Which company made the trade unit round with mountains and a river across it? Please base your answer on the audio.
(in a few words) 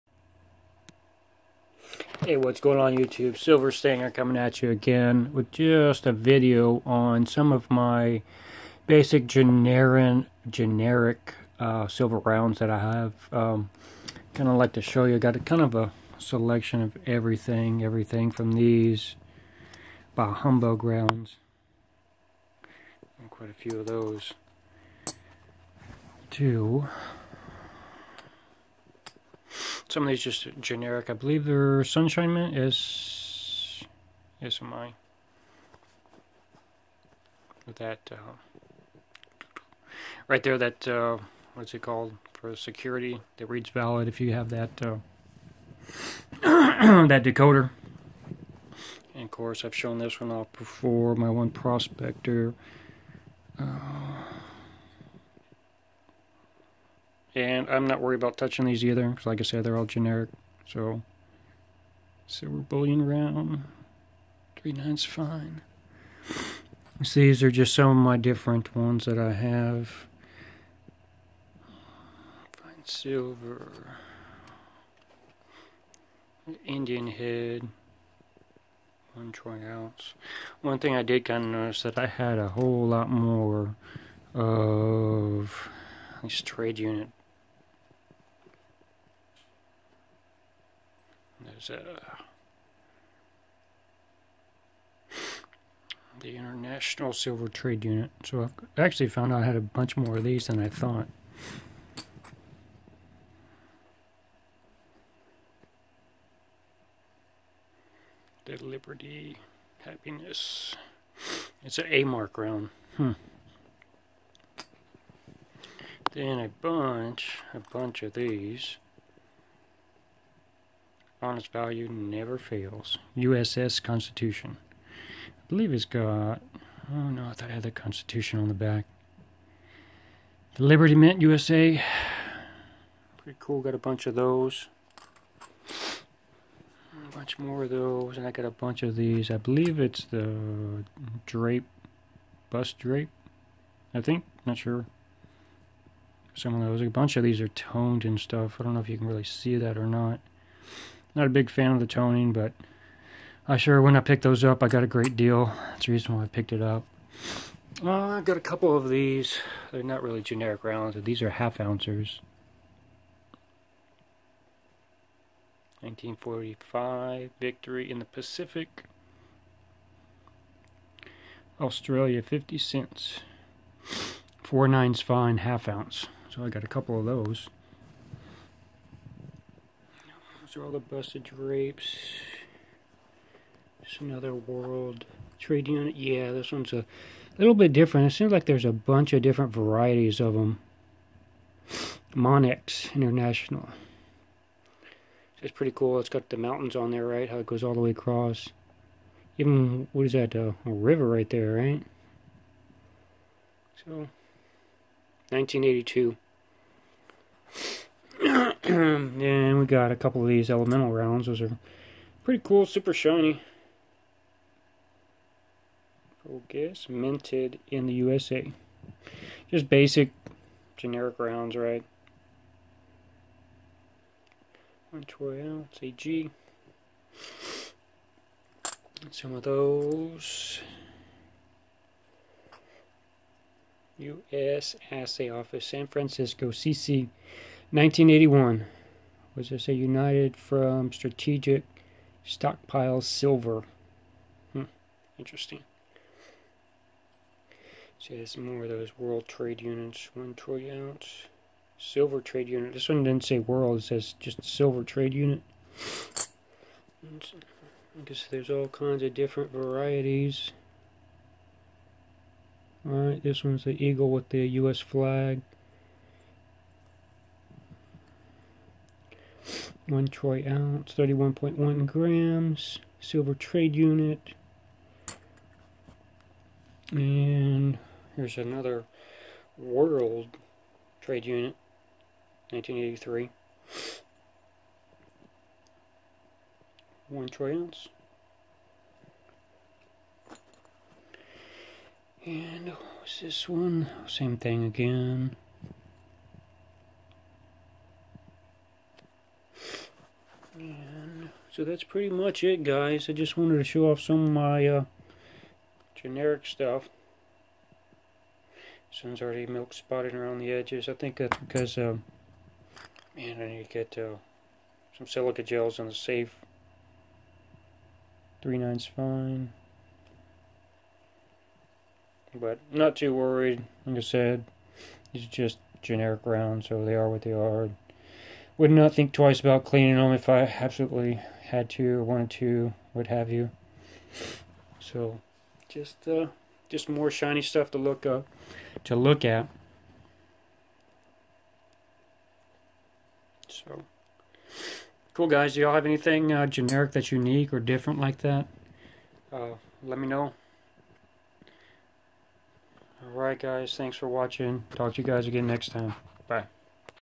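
Monex International.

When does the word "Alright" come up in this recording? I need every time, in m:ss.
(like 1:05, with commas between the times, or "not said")
4:22, 5:53.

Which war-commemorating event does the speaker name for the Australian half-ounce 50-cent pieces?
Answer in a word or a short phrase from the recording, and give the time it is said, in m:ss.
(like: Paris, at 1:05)
Victory in the Pacific, at 2:47.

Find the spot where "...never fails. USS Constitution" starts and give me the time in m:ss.
2:01.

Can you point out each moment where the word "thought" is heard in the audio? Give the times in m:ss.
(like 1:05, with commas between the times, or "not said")
1:40, 2:07.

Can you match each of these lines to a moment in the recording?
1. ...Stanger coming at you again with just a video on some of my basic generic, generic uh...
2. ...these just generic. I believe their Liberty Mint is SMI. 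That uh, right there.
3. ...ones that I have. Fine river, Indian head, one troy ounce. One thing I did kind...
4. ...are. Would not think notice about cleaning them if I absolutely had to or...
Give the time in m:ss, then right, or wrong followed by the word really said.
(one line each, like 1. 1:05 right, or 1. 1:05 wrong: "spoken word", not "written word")
1. 0:03 right
2. 0:30 wrong: "Sunshine", not "Liberty"
3. 1:08 wrong: "silver", not "river"
4. 5:27 wrong: "twice", not "notice".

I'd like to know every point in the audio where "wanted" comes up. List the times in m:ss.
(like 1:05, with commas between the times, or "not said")
5:03, 5:32.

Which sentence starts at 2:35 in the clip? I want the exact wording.
That's the reason why I picked it up.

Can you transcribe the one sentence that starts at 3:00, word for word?
Those are all the busted drapes.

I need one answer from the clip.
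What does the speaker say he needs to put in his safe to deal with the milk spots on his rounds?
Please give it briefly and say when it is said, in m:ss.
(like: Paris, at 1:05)
silica gels, at 5:15.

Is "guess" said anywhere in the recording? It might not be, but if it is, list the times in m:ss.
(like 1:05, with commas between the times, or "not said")
4:18.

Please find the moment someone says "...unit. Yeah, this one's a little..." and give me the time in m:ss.
3:05.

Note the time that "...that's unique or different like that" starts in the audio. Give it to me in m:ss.
5:46.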